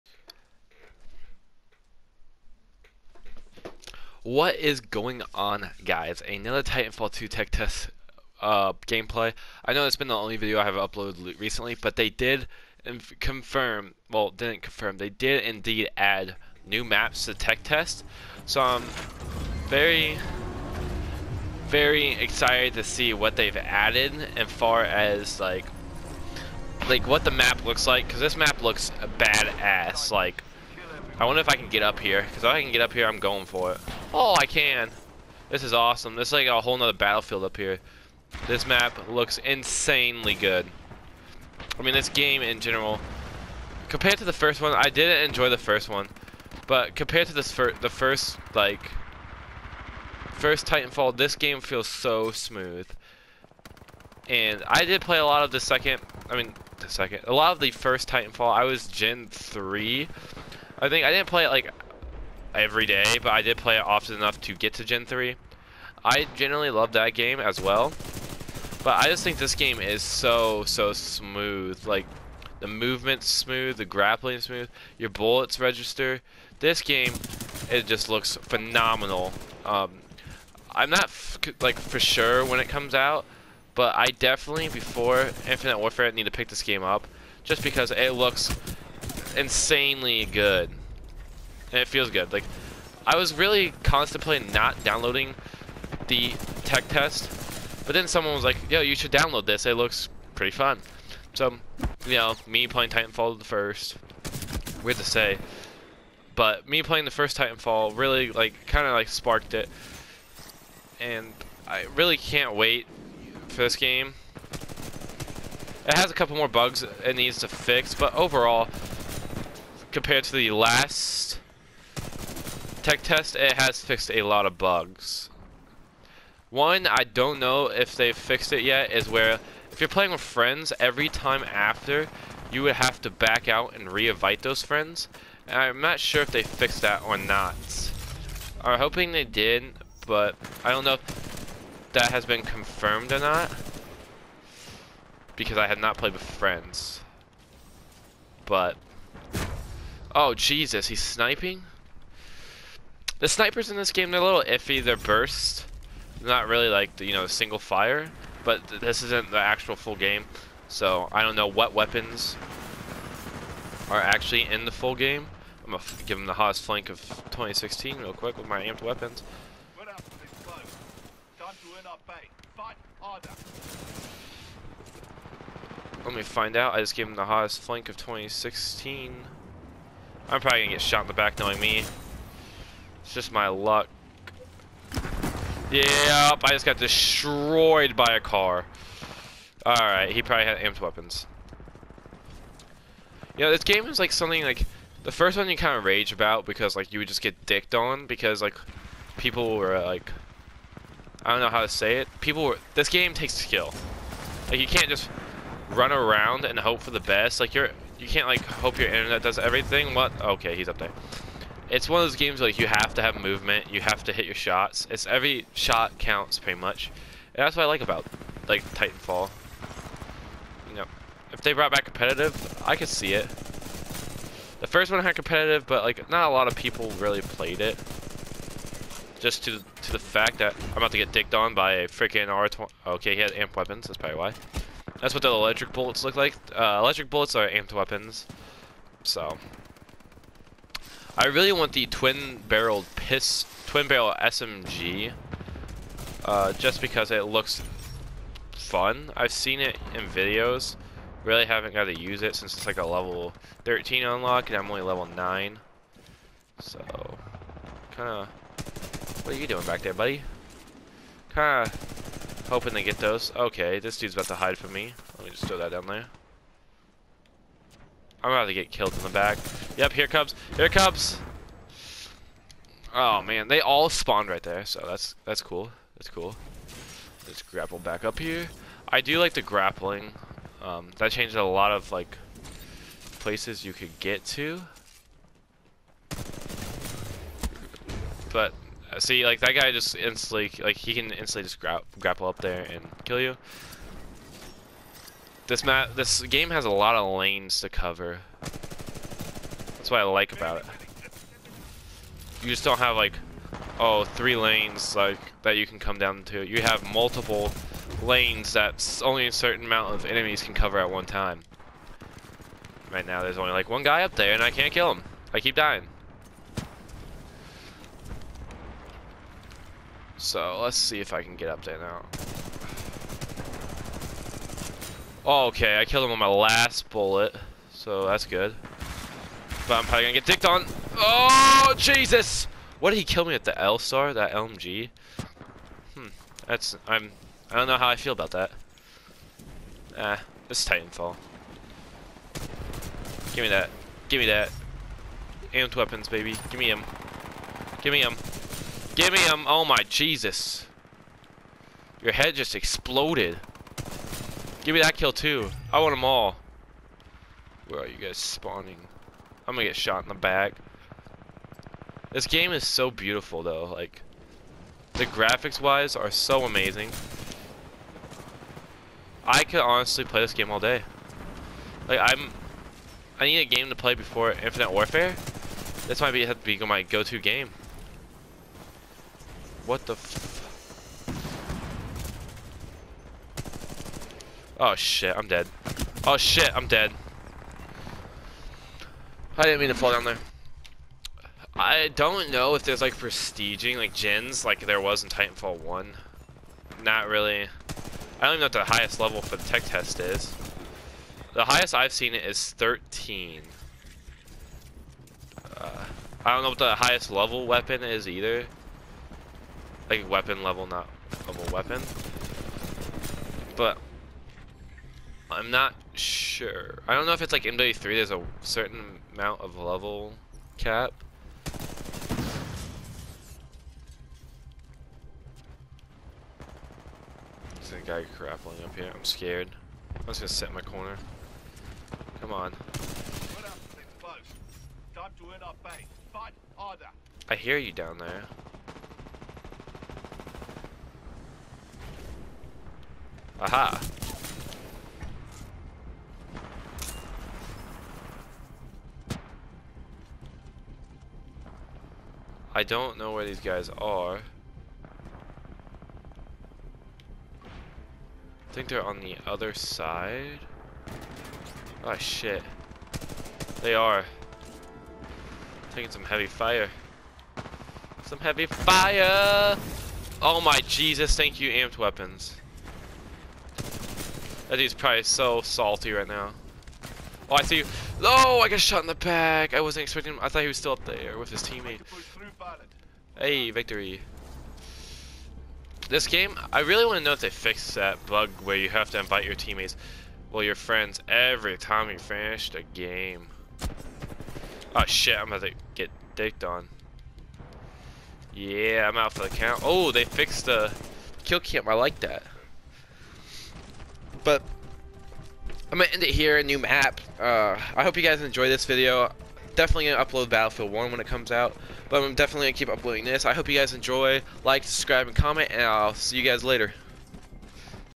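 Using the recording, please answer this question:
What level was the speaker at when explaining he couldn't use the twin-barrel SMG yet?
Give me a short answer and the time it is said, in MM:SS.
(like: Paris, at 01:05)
9, at 04:14.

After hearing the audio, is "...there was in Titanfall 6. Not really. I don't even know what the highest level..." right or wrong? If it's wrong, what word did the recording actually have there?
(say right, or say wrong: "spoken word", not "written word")
wrong: "1", not "6".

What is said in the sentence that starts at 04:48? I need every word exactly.
But uh, see, like that guy just instantly, like he can instantly just gra grapple up there and kill you.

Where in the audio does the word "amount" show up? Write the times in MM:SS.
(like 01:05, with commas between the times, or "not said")
05:09, 06:59.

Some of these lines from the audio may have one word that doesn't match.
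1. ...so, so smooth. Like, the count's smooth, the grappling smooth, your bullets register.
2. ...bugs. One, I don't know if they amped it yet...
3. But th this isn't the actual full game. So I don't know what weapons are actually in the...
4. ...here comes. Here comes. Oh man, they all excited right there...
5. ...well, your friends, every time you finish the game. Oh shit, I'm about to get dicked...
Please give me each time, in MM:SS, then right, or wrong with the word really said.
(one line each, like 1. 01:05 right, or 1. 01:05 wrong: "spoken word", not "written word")
1. 01:10 wrong: "movement", not "count"
2. 02:04 wrong: "fixed", not "amped"
3. 02:38 right
4. 04:29 wrong: "spawned", not "excited"
5. 08:10 right.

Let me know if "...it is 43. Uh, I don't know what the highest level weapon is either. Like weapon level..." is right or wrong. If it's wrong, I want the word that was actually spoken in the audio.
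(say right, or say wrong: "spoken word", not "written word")
wrong: "13", not "43".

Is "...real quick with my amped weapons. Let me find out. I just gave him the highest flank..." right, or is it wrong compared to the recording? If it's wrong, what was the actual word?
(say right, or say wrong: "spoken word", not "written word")
wrong: "hottest", not "highest".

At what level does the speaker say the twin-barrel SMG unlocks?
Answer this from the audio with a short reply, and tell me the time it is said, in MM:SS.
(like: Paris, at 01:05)
13, at 04:12.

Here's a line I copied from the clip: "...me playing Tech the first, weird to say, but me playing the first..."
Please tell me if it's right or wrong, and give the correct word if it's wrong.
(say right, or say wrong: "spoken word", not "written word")
wrong: "Titanfall", not "Tech".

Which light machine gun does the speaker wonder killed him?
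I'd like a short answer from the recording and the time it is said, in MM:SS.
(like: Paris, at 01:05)
L-STAR, at 05:33.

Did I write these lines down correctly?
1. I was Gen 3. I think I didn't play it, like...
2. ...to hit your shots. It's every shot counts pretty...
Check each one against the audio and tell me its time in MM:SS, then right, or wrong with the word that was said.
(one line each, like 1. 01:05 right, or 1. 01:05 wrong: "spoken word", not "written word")
1. 00:58 right
2. 03:34 right.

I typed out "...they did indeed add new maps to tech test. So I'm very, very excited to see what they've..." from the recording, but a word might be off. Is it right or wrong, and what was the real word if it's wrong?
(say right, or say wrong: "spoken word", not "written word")
right.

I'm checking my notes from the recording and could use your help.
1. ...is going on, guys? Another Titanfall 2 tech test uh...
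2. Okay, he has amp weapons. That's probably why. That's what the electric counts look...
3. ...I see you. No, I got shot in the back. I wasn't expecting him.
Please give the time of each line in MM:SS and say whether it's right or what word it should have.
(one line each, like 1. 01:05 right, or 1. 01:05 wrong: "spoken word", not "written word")
1. 00:04 right
2. 03:52 wrong: "bullets", not "counts"
3. 07:57 right.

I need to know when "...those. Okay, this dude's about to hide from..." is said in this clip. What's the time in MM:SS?
04:22.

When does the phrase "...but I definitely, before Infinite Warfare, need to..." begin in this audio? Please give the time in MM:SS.
01:23.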